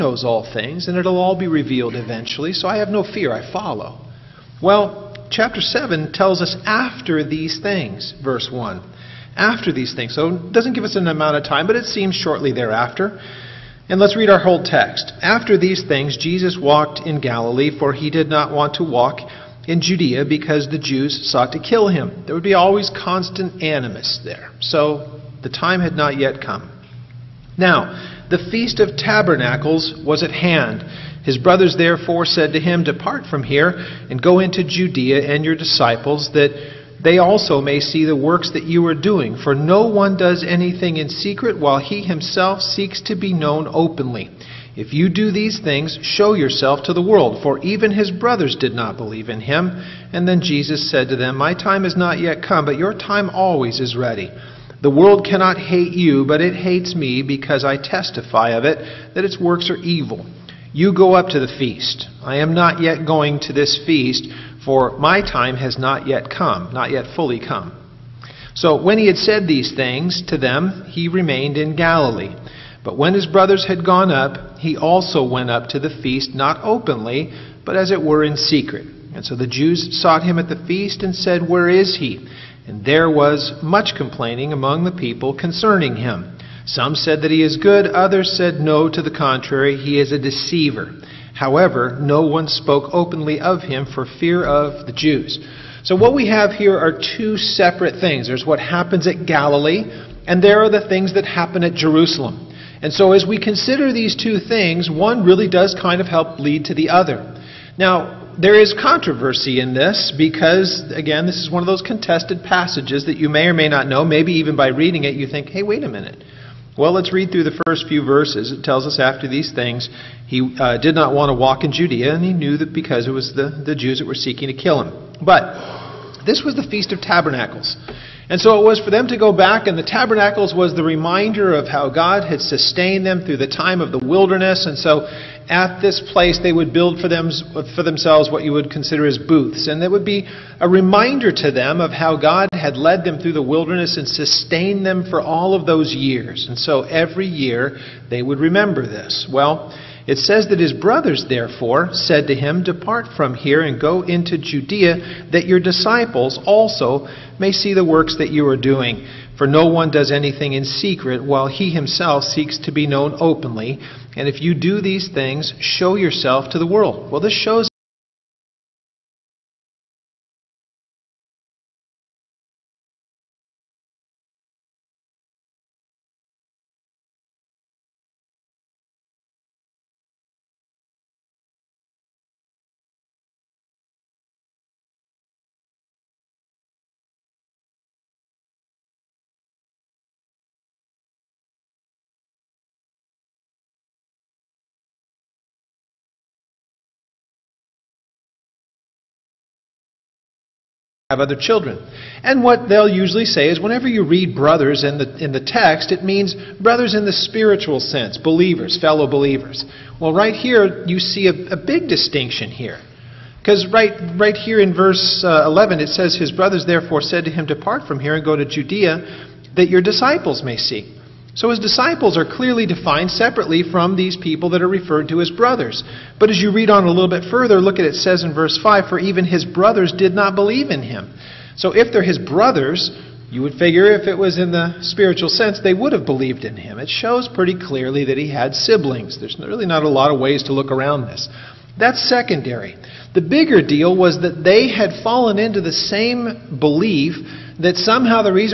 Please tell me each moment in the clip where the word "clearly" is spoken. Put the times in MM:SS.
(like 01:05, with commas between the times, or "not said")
03:42, 03:57.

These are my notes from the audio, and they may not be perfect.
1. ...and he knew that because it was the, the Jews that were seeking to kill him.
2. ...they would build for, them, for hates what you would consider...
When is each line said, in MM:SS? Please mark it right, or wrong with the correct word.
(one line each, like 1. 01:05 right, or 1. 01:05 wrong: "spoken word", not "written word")
1. 02:02 right
2. 02:16 wrong: "themselves", not "hates".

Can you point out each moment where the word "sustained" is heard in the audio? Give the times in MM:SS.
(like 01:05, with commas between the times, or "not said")
02:12, 02:24.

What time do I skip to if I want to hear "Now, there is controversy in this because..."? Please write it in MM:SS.
01:47.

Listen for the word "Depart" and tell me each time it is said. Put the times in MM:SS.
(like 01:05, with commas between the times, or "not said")
00:32, 02:32, 03:37.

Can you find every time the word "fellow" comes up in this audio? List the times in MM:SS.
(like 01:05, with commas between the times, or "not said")
03:28.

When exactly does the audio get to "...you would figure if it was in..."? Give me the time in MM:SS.
03:53.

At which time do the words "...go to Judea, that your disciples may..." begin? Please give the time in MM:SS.
03:38.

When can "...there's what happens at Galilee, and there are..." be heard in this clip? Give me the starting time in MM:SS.
01:38.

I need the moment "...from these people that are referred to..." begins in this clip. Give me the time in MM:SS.
03:43.